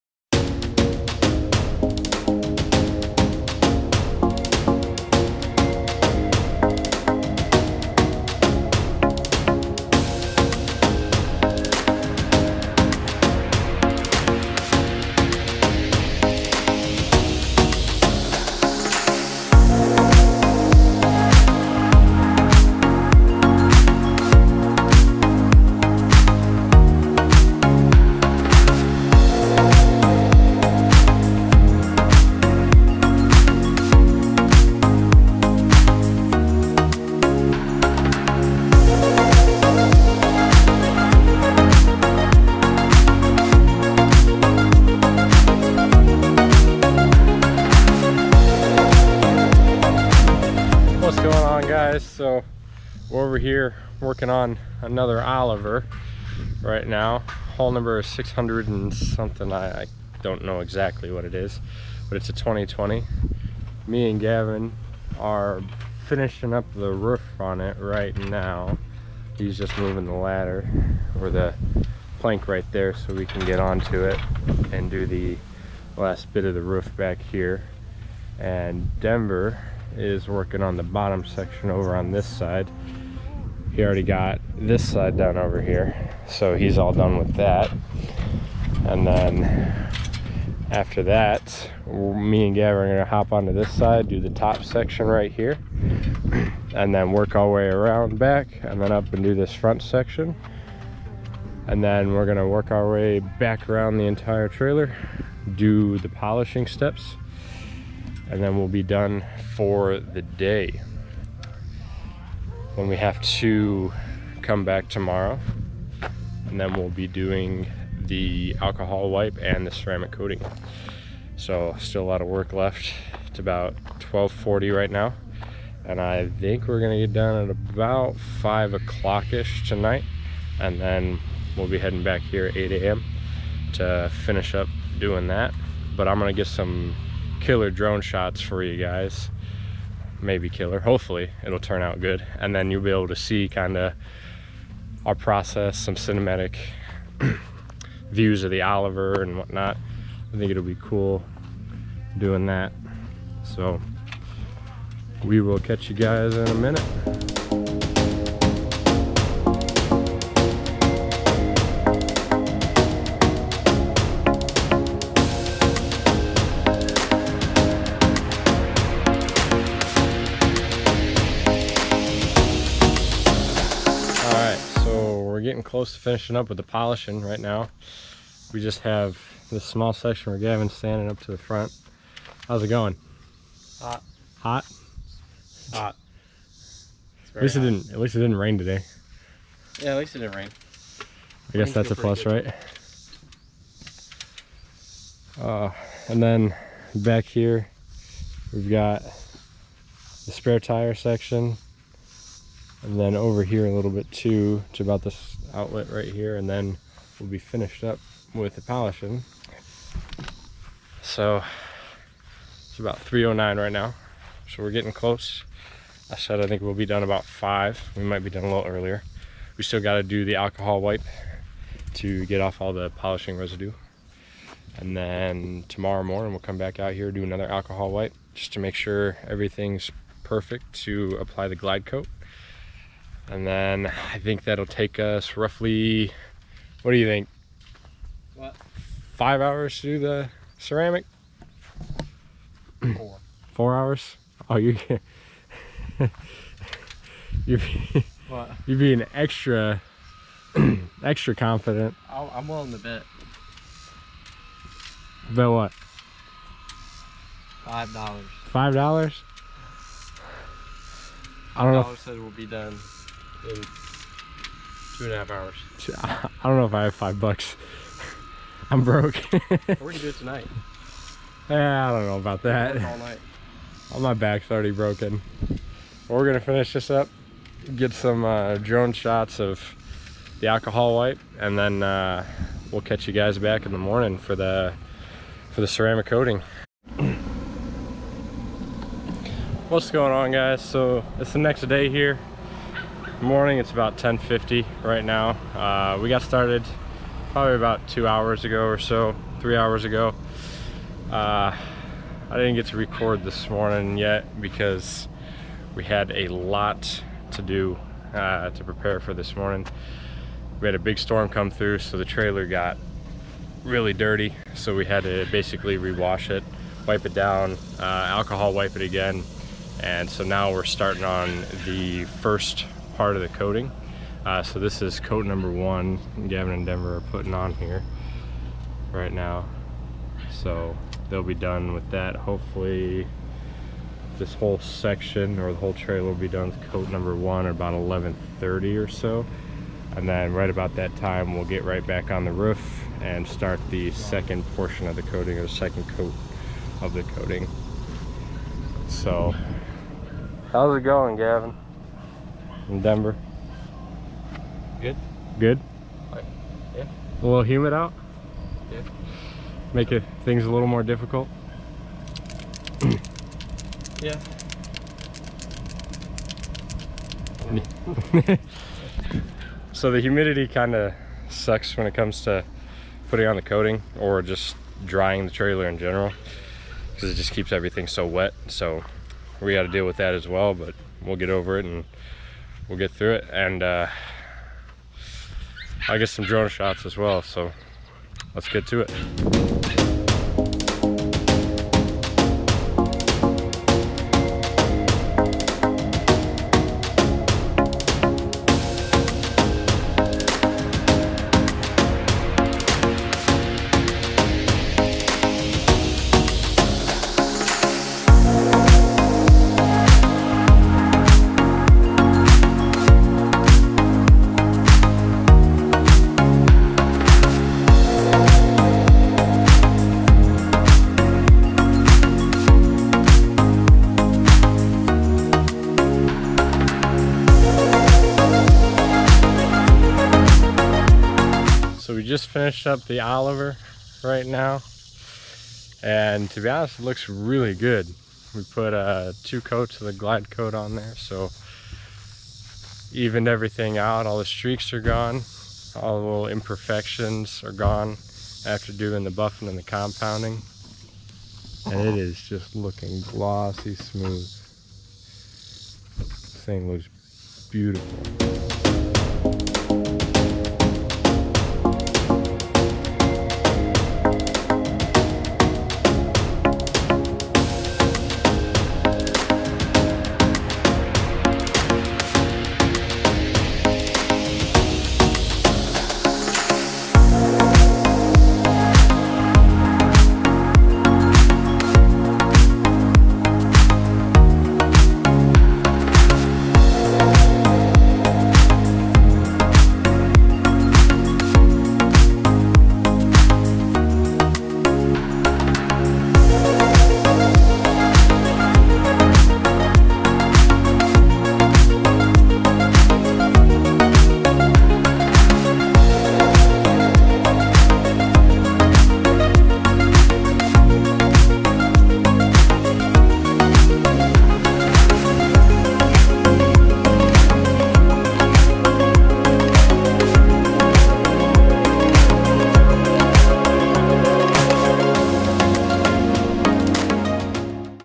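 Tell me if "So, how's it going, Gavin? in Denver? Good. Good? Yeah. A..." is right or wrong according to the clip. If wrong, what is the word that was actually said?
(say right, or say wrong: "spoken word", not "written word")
right.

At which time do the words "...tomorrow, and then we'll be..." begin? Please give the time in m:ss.
1:54.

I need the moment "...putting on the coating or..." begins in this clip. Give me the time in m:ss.
6:13.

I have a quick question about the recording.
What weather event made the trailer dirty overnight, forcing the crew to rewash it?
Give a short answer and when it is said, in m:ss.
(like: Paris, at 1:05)
A big storm, at 5:10.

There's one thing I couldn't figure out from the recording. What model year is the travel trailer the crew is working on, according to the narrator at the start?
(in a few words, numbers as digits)
2020.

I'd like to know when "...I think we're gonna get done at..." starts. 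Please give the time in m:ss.
2:05.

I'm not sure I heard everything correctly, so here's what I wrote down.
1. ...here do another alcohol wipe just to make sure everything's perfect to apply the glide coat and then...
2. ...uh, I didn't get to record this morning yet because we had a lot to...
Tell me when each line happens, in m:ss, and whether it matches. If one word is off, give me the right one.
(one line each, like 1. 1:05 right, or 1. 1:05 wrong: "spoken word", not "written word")
1. 3:46 right
2. 5:01 right.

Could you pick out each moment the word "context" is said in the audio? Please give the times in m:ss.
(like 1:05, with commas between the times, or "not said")
not said.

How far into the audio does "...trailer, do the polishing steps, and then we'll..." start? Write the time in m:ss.
1:44.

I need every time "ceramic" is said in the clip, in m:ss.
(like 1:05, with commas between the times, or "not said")
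1:59, 4:00, 4:45.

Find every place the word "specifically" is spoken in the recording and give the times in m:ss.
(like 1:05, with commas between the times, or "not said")
not said.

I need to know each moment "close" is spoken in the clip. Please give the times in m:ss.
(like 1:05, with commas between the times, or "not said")
2:55, 3:34.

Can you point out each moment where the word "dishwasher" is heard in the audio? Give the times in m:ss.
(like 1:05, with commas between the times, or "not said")
not said.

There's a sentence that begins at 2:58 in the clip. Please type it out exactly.
We just have this small section where Gavin's standing up to the front.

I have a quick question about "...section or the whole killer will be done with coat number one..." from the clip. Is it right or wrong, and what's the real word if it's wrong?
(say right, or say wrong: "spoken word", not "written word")
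wrong: "trailer", not "killer".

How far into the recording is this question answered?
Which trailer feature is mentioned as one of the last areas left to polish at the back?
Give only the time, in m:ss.
3:20.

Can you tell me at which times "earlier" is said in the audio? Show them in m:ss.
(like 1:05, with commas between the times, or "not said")
3:38.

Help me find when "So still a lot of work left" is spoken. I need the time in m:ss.
2:01.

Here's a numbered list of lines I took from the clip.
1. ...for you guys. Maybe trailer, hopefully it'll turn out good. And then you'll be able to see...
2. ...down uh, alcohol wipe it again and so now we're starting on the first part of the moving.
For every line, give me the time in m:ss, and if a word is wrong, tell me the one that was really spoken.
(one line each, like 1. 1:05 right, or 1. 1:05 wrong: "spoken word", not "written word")
1. 2:18 wrong: "killer", not "trailer"
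2. 5:17 wrong: "coating", not "moving".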